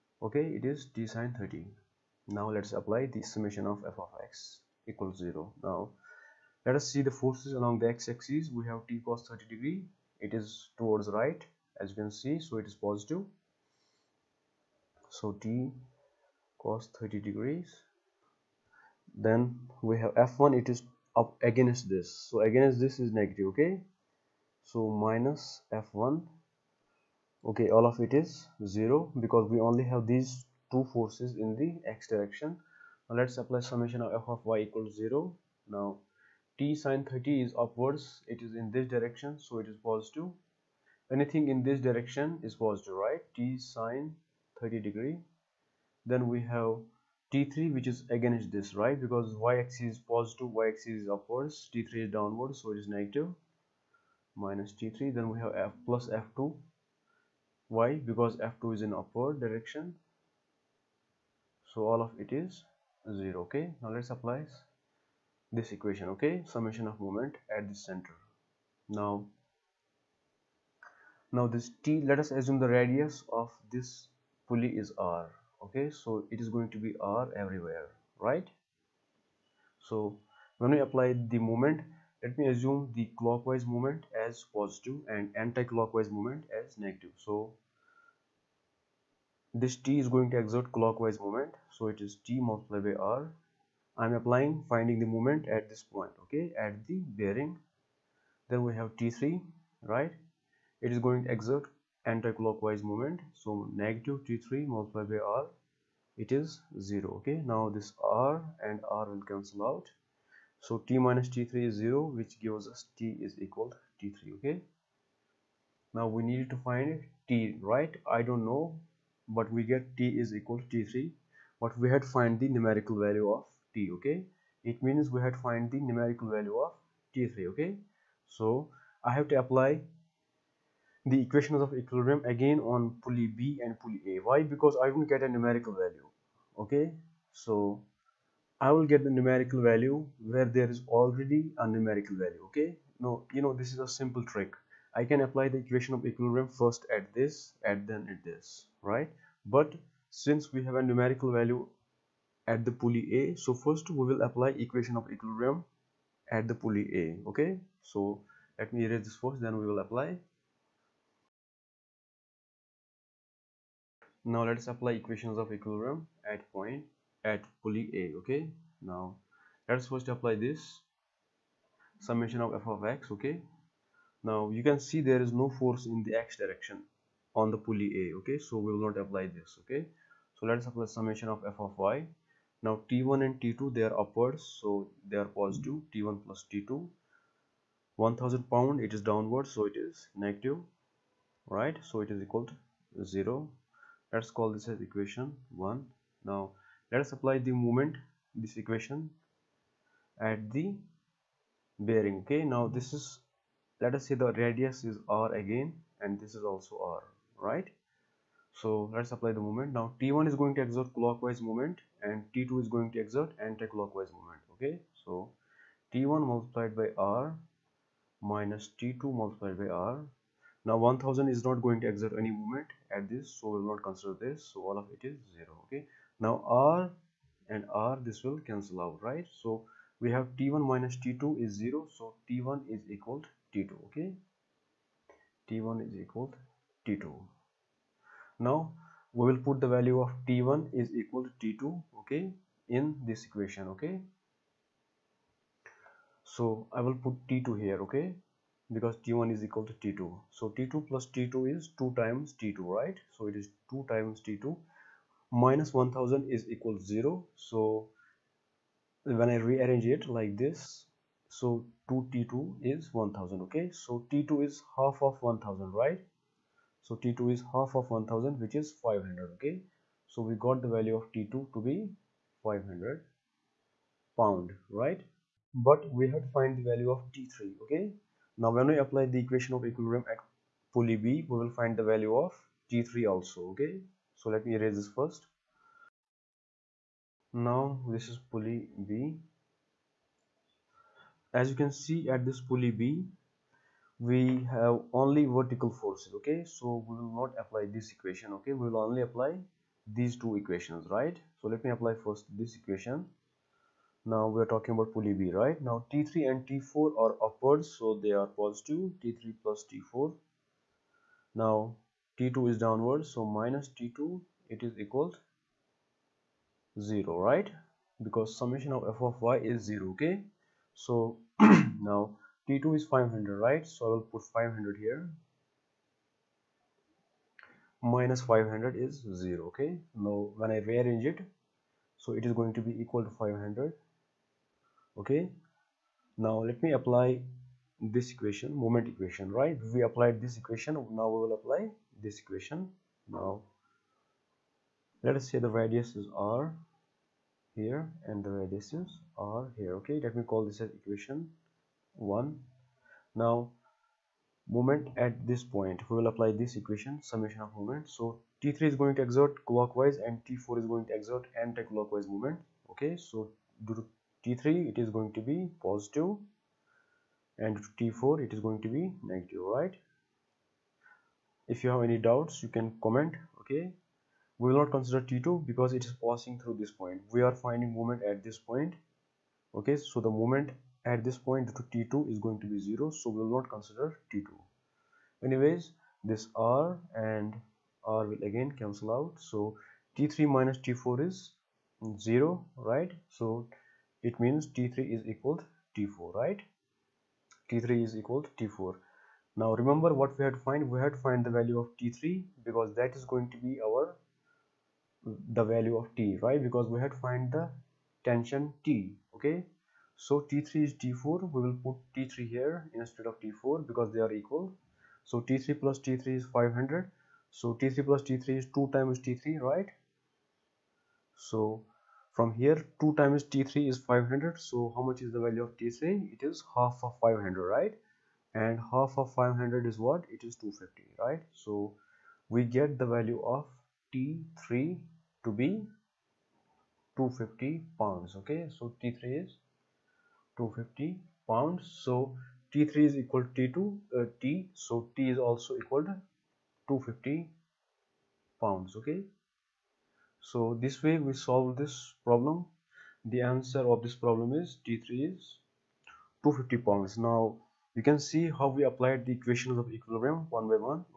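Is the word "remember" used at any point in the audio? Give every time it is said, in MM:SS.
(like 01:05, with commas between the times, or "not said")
06:39.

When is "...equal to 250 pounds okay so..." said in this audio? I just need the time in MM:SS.
07:25.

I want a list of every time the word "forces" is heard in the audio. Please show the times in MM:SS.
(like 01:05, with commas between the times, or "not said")
00:07, 00:30, 02:55, 04:55.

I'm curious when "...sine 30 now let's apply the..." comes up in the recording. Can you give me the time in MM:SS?
00:01.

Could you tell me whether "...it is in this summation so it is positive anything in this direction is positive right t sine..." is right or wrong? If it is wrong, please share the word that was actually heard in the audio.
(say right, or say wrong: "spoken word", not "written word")
wrong: "direction", not "summation".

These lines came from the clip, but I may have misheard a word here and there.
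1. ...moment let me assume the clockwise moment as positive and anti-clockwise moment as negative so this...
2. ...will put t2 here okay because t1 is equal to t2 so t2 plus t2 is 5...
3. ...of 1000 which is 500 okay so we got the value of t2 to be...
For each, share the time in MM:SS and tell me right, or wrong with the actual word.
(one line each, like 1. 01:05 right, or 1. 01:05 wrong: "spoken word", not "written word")
1. 01:21 right
2. 04:06 wrong: "2", not "5"
3. 04:27 right.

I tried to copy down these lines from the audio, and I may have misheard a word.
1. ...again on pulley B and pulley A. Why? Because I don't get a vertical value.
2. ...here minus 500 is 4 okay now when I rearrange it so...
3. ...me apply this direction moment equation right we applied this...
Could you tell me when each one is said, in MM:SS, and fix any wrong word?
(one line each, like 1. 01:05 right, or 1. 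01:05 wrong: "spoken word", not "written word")
1. 02:12 wrong: "numerical", not "vertical"
2. 05:24 wrong: "0", not "4"
3. 05:36 wrong: "equation", not "direction".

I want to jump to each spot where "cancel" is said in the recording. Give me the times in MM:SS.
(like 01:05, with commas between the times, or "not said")
01:49, 03:48, 06:28.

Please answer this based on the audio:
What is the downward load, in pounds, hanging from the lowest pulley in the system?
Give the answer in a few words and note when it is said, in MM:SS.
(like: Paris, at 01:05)
1000 pounds, at 03:08.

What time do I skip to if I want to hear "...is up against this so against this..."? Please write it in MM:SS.
00:20.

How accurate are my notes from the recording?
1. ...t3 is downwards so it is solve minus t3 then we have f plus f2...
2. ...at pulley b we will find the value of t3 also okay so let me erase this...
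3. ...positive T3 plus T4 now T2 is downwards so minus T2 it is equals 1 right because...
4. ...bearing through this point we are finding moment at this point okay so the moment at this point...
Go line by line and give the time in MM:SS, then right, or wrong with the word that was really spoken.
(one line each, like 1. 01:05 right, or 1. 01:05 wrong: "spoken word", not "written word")
1. 00:51 wrong: "negative", not "solve"
2. 04:40 right
3. 05:08 wrong: "0", not "1"
4. 06:16 wrong: "passing", not "bearing".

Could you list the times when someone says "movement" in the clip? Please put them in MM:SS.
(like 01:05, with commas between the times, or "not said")
03:42.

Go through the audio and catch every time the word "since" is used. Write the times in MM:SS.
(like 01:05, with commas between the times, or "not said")
02:30.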